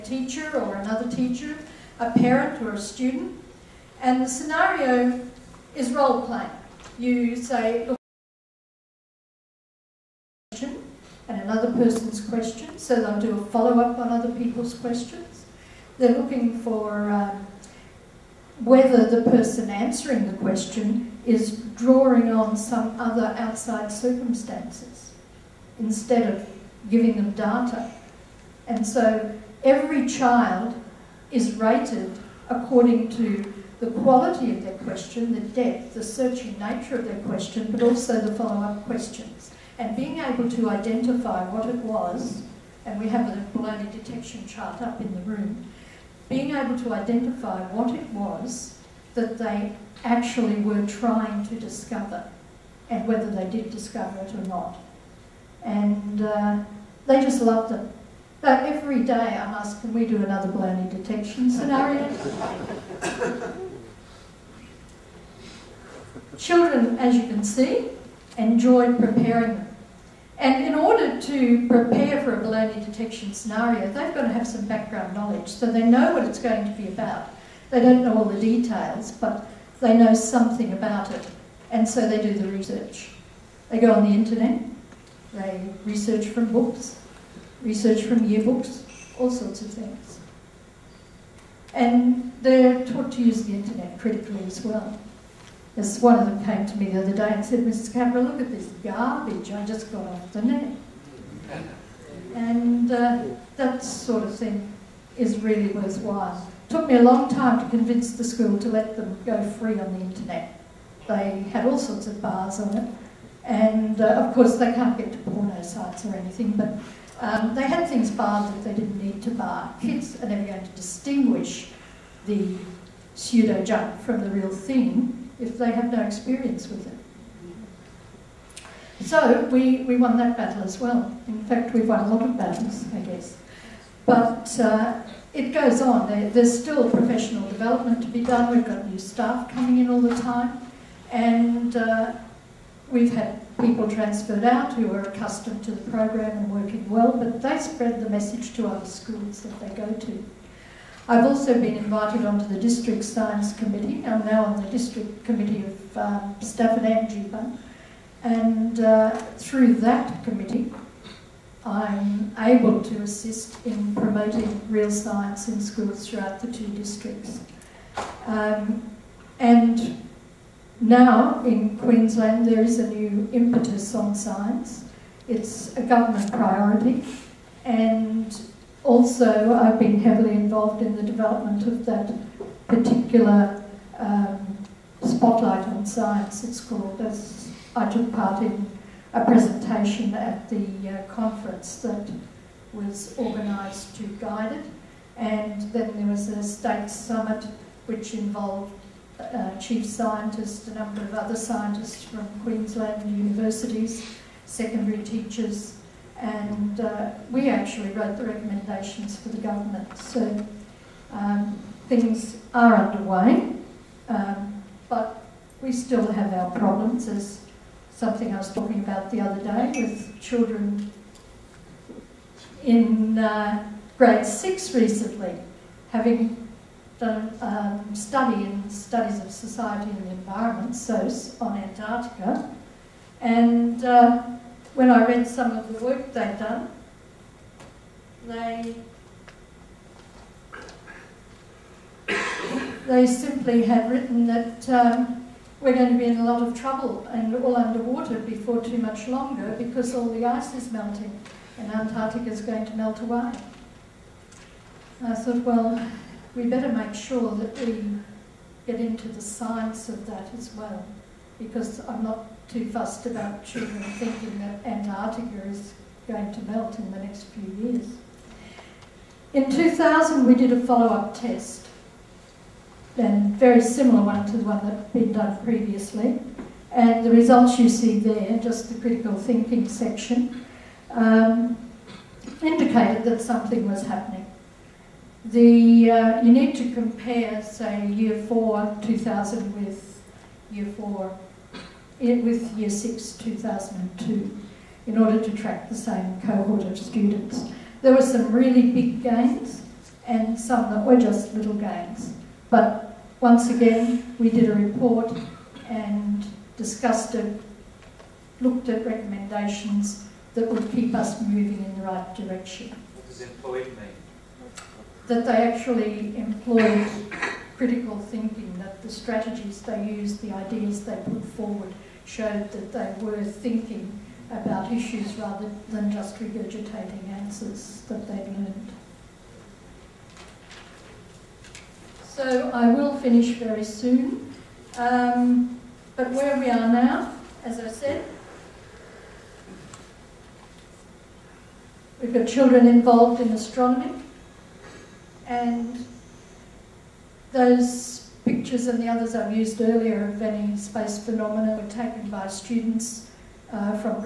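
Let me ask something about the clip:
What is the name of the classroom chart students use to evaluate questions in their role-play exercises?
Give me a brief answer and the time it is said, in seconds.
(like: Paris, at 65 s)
Baloney detection chart, at 43 s.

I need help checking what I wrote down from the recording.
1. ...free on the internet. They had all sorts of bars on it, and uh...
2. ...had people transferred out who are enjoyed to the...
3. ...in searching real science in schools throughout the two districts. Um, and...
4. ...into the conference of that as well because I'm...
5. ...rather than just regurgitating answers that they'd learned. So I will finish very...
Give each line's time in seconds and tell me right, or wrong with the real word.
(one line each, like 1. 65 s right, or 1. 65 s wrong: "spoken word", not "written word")
1. 109 s right
2. 143 s wrong: "accustomed", not "enjoyed"
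3. 163 s wrong: "promoting", not "searching"
4. 258 s wrong: "science", not "conference"
5. 325 s right.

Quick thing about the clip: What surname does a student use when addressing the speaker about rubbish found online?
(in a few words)
Cameron.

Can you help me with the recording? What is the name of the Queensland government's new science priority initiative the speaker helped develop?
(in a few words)
Spotlight on science.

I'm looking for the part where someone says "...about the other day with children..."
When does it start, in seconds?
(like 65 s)
218 s.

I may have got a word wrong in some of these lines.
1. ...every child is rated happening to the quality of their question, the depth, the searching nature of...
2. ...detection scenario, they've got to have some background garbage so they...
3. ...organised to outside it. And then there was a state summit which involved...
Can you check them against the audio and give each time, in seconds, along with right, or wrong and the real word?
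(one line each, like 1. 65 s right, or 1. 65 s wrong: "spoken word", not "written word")
1. 29 s wrong: "according", not "happening"
2. 72 s wrong: "knowledge", not "garbage"
3. 193 s wrong: "guide", not "outside".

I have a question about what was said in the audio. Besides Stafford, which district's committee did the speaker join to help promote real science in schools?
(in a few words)
Geebung.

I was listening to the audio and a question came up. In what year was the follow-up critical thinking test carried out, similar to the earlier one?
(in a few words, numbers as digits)
2000.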